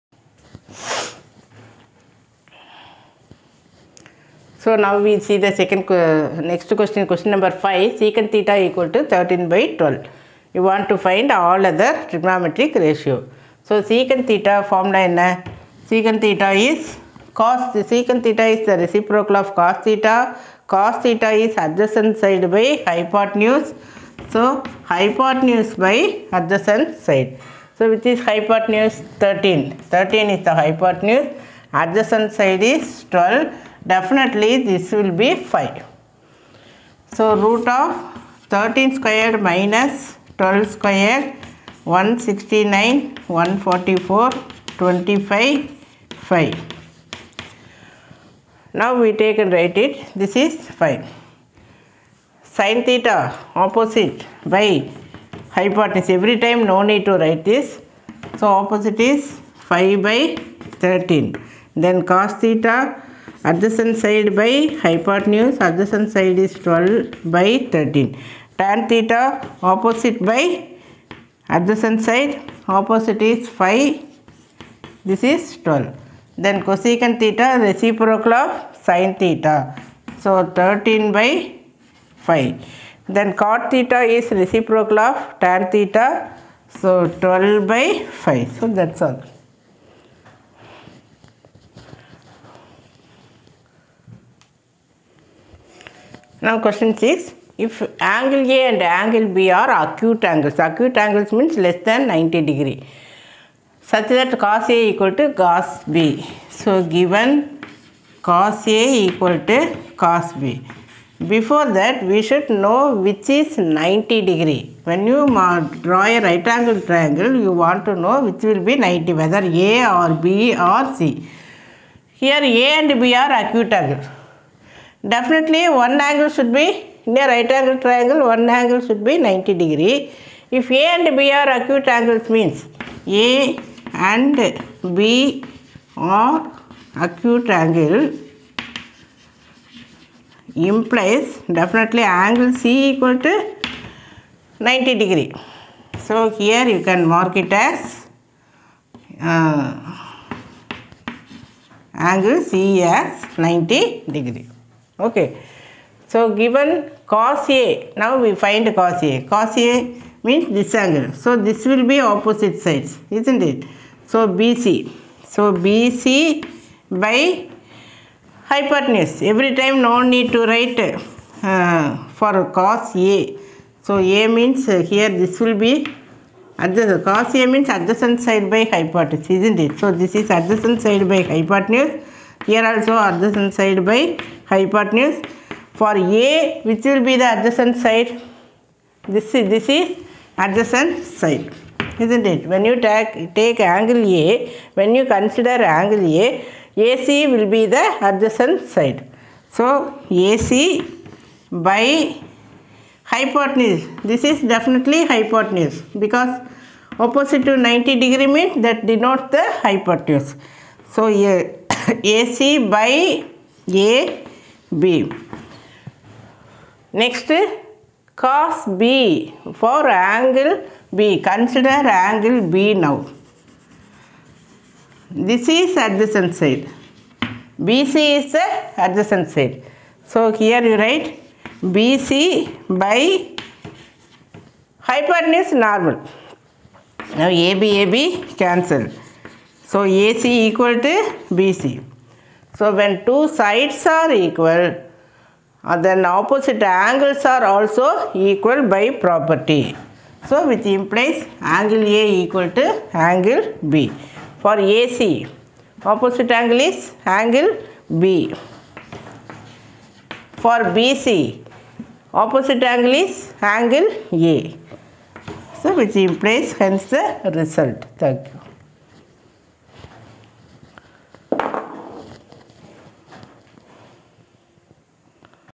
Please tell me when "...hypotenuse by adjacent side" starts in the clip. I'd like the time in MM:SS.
00:24.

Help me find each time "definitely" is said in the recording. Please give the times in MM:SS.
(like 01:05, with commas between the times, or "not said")
00:33, 02:05, 02:21, 03:24.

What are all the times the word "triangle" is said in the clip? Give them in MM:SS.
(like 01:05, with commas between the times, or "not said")
01:56, 02:07.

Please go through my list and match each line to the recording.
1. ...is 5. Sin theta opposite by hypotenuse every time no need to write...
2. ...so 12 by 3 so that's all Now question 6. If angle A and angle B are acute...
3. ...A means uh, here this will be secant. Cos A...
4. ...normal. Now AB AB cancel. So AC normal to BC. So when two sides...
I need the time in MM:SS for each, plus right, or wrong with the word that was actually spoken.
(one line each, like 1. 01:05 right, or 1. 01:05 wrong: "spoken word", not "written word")
1. 00:50 right
2. 01:26 wrong: "5", not "3"
3. 02:53 wrong: "adjacent", not "secant"
4. 03:55 wrong: "equal", not "normal".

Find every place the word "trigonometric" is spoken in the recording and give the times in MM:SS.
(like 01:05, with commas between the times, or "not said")
00:12.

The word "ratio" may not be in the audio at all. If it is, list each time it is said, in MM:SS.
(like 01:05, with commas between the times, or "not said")
00:12.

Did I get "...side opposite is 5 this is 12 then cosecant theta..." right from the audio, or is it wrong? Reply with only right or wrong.
right.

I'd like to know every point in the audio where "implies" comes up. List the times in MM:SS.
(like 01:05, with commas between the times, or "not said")
02:20, 04:10, 04:25.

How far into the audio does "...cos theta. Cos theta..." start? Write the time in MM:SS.
00:19.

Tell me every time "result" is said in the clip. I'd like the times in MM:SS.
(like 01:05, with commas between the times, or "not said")
04:27.